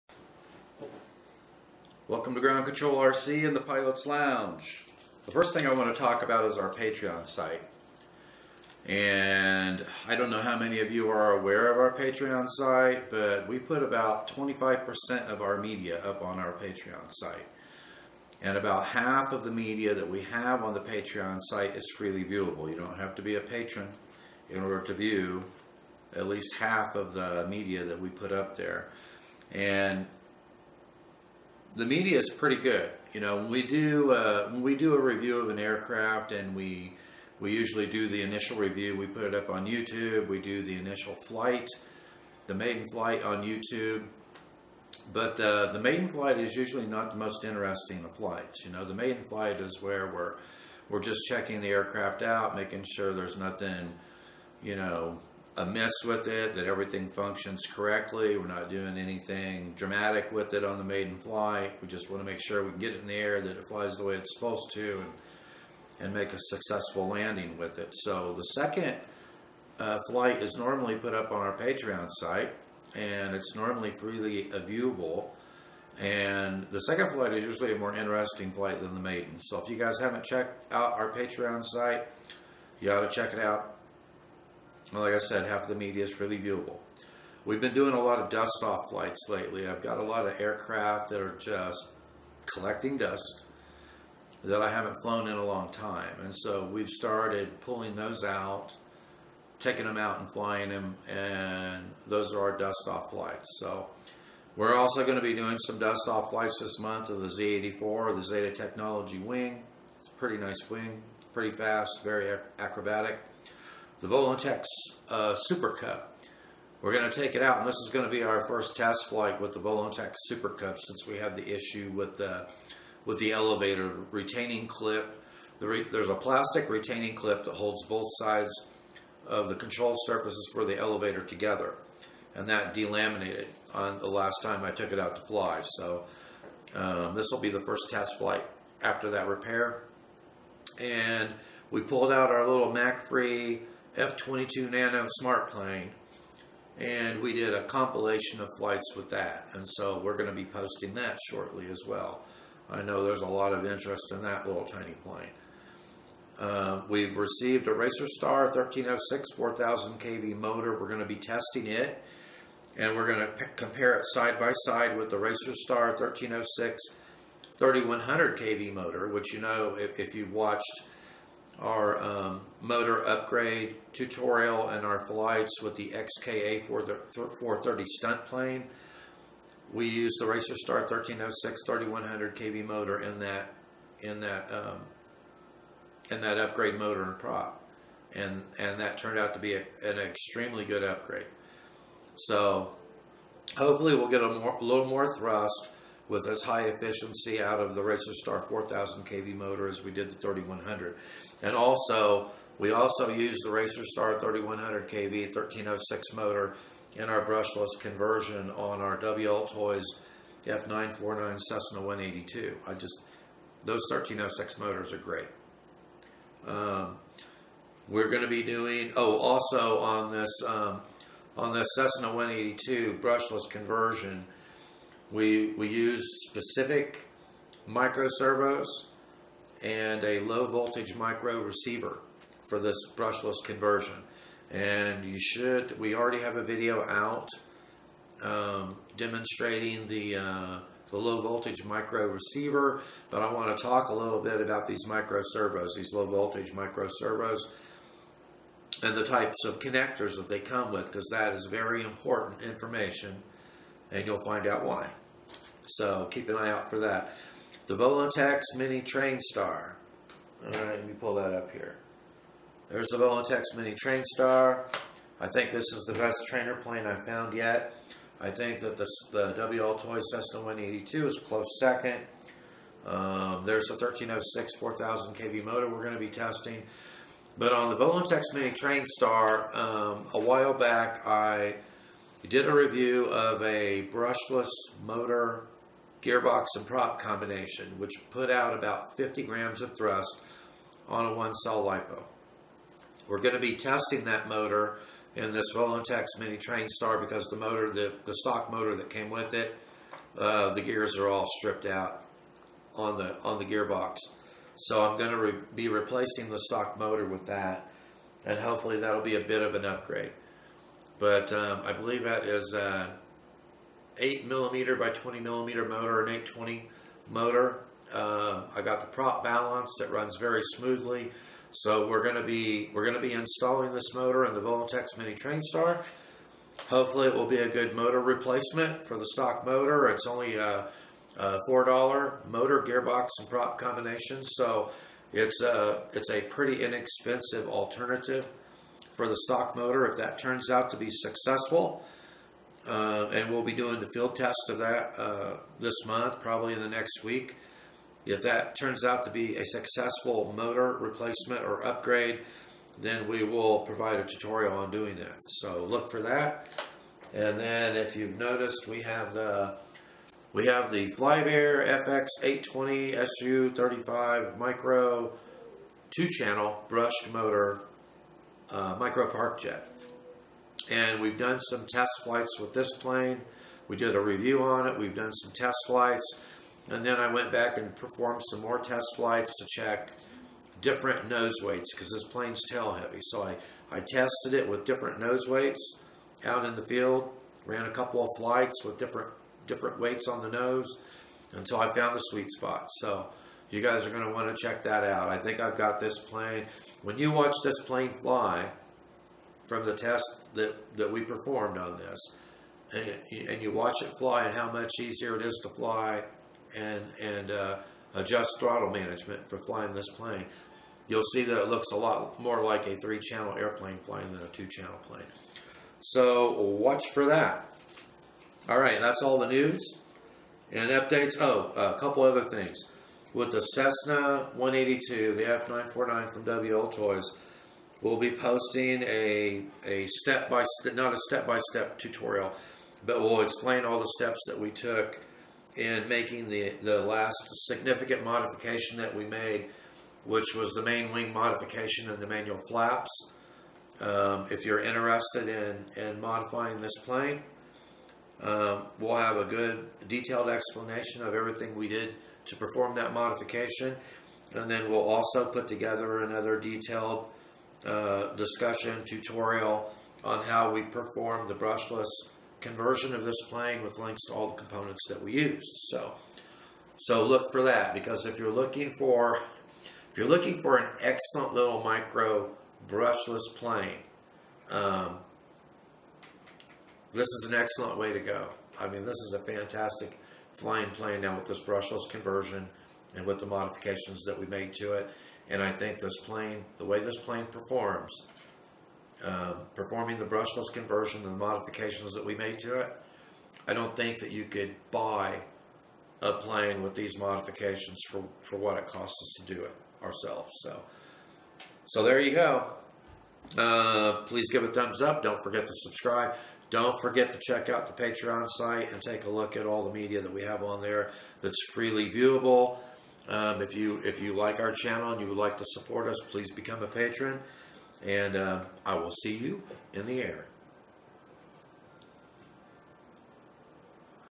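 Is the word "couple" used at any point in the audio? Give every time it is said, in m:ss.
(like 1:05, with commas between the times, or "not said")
6:27, 7:01.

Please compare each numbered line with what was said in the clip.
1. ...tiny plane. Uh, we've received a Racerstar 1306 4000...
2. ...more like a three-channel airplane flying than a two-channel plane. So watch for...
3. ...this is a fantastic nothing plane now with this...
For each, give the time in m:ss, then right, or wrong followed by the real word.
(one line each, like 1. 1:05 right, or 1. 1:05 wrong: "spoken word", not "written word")
1. 2:34 right
2. 6:52 right
3. 7:58 wrong: "flying", not "nothing".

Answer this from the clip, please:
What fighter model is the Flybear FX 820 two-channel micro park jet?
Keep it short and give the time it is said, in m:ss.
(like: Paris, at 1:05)
SU 35, at 6:03.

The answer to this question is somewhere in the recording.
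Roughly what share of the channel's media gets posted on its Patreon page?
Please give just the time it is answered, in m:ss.
0:14.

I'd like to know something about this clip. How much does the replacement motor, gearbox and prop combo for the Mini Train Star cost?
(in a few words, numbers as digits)
4 dollars.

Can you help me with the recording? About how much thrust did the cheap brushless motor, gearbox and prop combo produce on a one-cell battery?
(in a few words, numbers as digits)
50 grams.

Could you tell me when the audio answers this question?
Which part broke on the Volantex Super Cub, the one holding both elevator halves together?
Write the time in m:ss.
2:03.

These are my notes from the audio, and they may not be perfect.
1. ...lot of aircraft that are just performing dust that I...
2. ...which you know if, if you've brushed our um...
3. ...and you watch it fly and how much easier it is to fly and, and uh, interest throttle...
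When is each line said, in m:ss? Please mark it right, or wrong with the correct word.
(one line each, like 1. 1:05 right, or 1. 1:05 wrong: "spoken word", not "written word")
1. 1:30 wrong: "collecting", not "performing"
2. 2:49 wrong: "watched", not "brushed"
3. 6:43 wrong: "adjust", not "interest".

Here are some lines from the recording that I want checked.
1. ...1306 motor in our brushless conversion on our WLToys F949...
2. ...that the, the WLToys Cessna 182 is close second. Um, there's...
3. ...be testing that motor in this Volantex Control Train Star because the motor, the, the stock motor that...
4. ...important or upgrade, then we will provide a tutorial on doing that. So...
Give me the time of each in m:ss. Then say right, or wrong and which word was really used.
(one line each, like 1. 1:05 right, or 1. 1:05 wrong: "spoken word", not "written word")
1. 3:25 right
2. 4:28 right
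3. 4:53 wrong: "Mini", not "Control"
4. 5:50 wrong: "replacement", not "important".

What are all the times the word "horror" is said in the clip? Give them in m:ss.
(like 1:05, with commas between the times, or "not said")
not said.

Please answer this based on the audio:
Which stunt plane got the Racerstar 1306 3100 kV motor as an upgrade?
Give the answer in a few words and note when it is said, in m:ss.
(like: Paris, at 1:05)
XK A430, at 2:55.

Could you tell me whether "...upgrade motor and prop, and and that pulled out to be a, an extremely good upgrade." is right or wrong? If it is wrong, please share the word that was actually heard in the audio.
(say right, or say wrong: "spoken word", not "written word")
wrong: "turned", not "pulled".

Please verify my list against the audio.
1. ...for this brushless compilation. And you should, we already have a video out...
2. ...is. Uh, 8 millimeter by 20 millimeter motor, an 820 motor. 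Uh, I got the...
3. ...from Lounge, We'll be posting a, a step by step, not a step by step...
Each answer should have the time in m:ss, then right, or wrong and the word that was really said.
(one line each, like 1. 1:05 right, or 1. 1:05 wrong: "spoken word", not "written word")
1. 3:52 wrong: "conversion", not "compilation"
2. 5:12 right
3. 7:06 wrong: "WLToys", not "Lounge".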